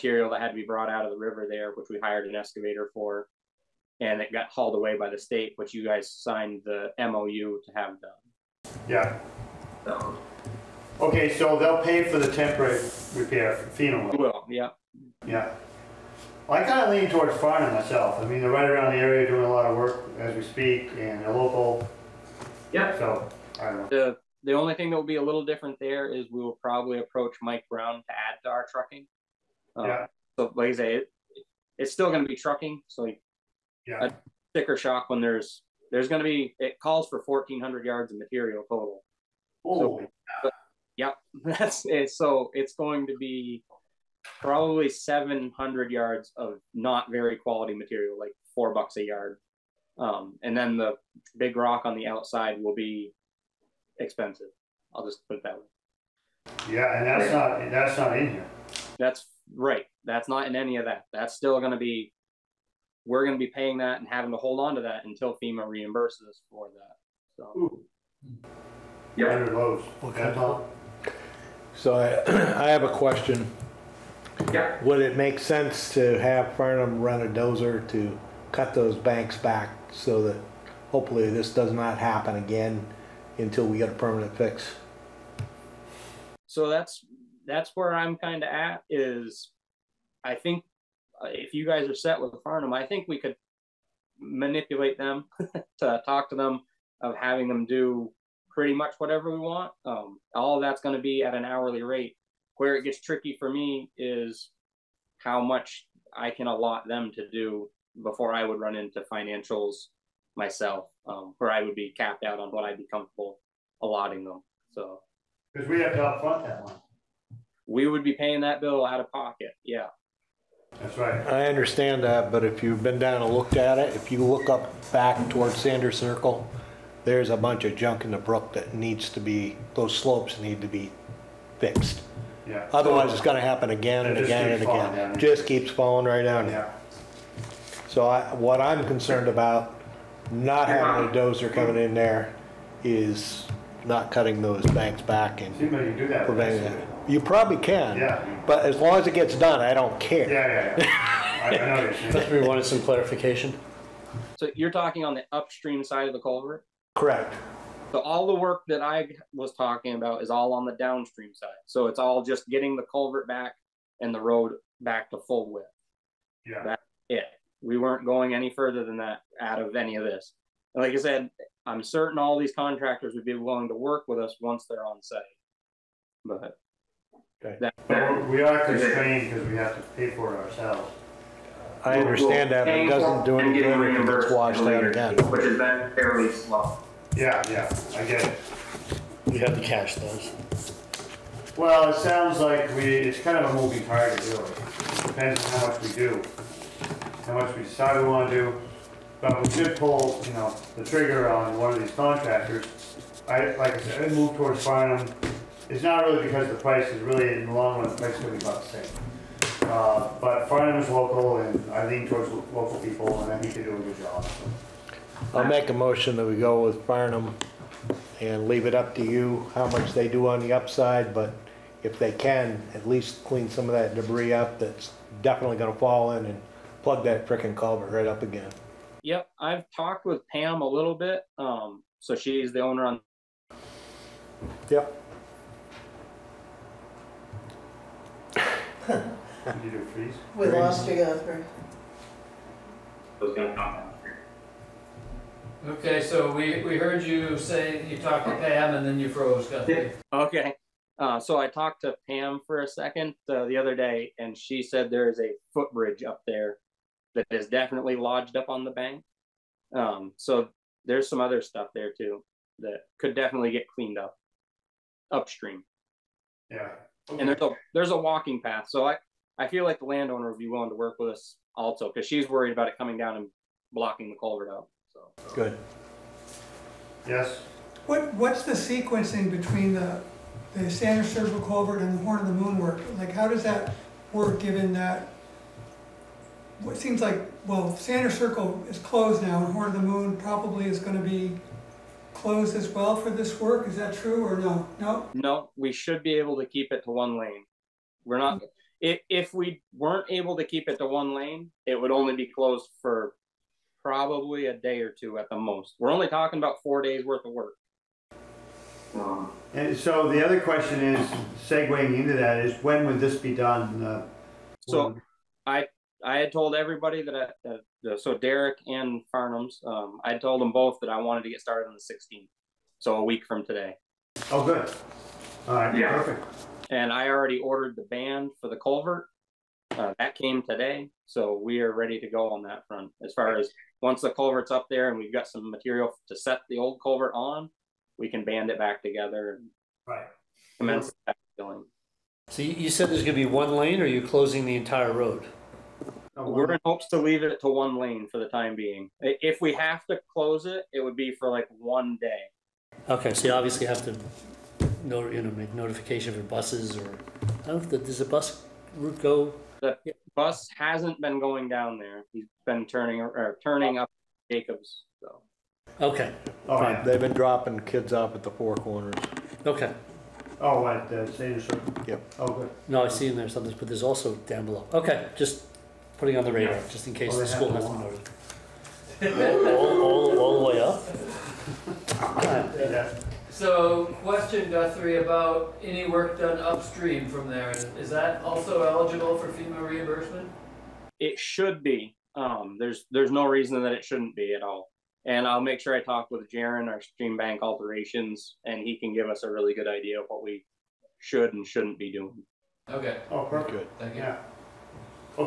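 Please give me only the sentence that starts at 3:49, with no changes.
Yep, I've talked with Pam a little bit.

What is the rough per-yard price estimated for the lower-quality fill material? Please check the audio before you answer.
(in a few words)
$4.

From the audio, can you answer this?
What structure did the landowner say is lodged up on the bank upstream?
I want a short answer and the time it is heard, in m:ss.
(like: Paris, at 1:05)
A footbridge, at 4:15.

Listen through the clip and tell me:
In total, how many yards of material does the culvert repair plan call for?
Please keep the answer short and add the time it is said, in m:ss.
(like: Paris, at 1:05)
1400, at 0:37.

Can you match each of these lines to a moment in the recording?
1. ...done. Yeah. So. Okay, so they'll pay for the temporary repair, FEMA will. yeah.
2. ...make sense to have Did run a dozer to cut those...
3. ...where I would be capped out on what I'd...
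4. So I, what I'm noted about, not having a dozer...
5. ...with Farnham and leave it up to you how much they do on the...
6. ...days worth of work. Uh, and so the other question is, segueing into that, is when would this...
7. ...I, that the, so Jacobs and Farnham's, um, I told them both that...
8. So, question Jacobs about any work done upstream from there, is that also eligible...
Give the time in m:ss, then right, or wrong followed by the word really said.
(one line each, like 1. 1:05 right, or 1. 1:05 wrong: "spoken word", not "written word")
1. 0:08 right
2. 1:15 wrong: "Farnham", not "Did"
3. 1:51 right
4. 2:17 wrong: "concerned", not "noted"
5. 3:36 right
6. 5:06 right
7. 5:17 wrong: "Derek", not "Jacobs"
8. 6:23 wrong: "Guthrie", not "Jacobs".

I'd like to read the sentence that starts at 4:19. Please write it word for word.
Um, so there's some other stuff there too that could definitely get cleaned up upstream.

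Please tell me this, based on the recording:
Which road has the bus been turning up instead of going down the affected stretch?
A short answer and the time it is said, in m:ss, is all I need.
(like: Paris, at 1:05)
Jacobs, at 6:04.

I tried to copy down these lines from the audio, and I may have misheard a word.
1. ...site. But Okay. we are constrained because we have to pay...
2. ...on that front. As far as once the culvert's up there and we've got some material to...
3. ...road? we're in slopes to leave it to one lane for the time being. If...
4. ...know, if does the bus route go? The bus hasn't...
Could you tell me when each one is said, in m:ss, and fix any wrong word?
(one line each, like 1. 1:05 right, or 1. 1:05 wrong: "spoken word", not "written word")
1. 2:55 right
2. 5:32 right
3. 5:44 wrong: "hopes", not "slopes"
4. 5:57 right.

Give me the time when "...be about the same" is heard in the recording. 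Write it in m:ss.
3:28.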